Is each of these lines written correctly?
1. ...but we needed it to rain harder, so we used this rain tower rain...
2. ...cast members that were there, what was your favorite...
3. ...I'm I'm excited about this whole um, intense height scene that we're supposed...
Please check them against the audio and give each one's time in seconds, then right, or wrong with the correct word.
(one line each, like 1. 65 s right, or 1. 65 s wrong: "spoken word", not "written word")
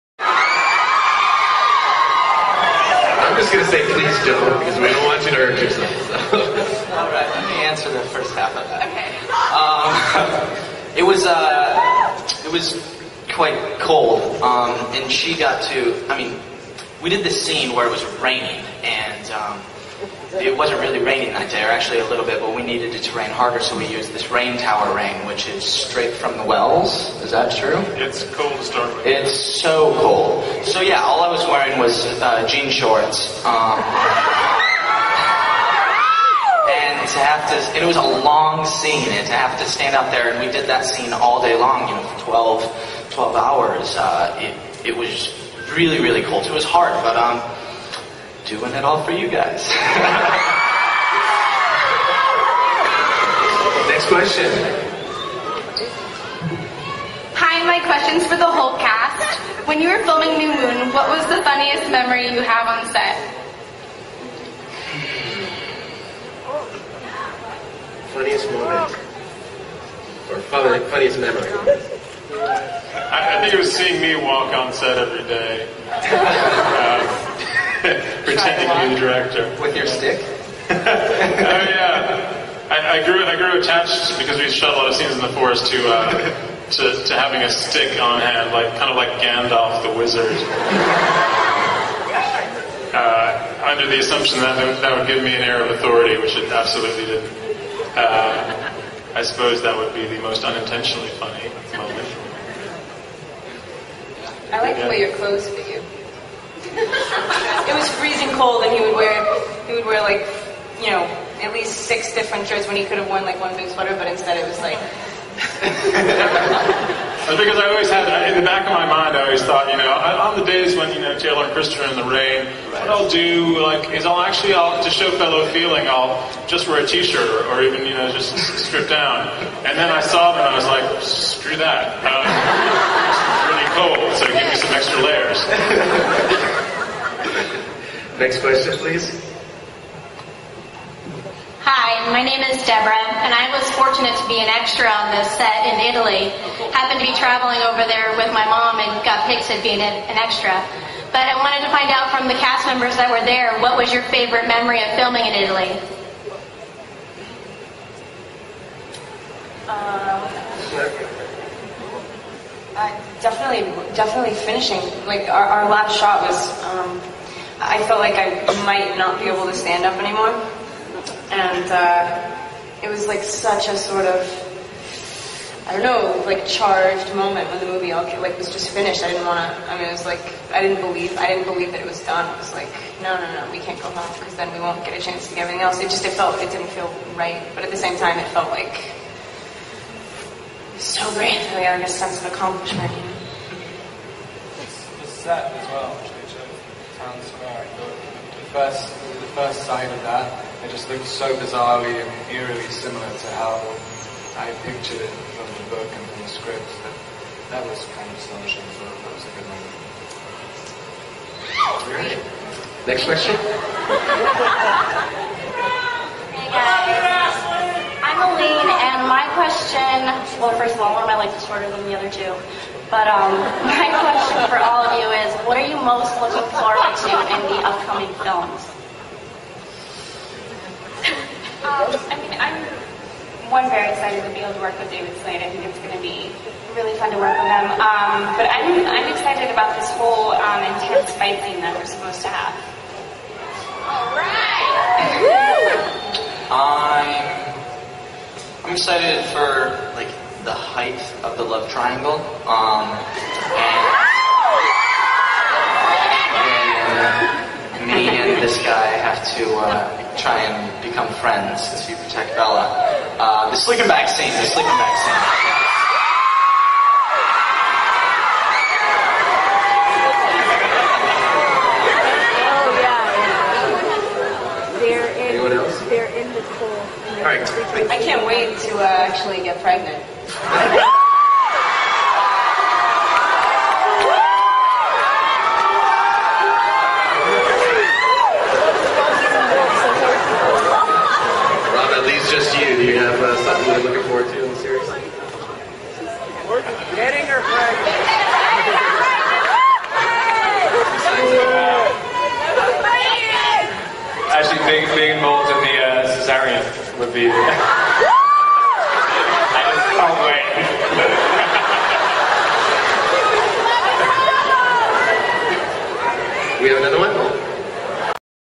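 1. 22 s right
2. 152 s right
3. 238 s wrong: "fight", not "height".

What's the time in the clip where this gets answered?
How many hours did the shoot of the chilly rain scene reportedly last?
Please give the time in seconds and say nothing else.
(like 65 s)
43 s.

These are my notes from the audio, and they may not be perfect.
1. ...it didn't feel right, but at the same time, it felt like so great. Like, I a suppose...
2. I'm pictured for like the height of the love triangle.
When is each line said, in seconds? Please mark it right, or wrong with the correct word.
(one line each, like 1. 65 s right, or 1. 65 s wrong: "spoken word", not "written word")
1. 186 s wrong: "sense", not "suppose"
2. 248 s wrong: "excited", not "pictured".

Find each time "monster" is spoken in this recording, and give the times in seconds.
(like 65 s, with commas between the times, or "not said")
not said.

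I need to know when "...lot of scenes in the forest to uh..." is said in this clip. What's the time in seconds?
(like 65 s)
84 s.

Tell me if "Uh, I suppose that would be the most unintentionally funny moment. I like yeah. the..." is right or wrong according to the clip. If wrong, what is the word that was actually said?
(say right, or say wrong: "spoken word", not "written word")
right.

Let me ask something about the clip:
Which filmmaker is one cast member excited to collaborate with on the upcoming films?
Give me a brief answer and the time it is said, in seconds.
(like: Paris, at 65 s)
David Slade, at 234 s.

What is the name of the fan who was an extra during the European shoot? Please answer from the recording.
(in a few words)
Deborah.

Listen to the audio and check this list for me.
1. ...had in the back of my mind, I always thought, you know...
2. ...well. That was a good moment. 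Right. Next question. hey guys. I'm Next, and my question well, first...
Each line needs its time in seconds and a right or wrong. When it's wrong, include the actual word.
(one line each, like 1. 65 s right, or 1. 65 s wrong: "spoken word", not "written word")
1. 117 s right
2. 208 s wrong: "Aline", not "Next".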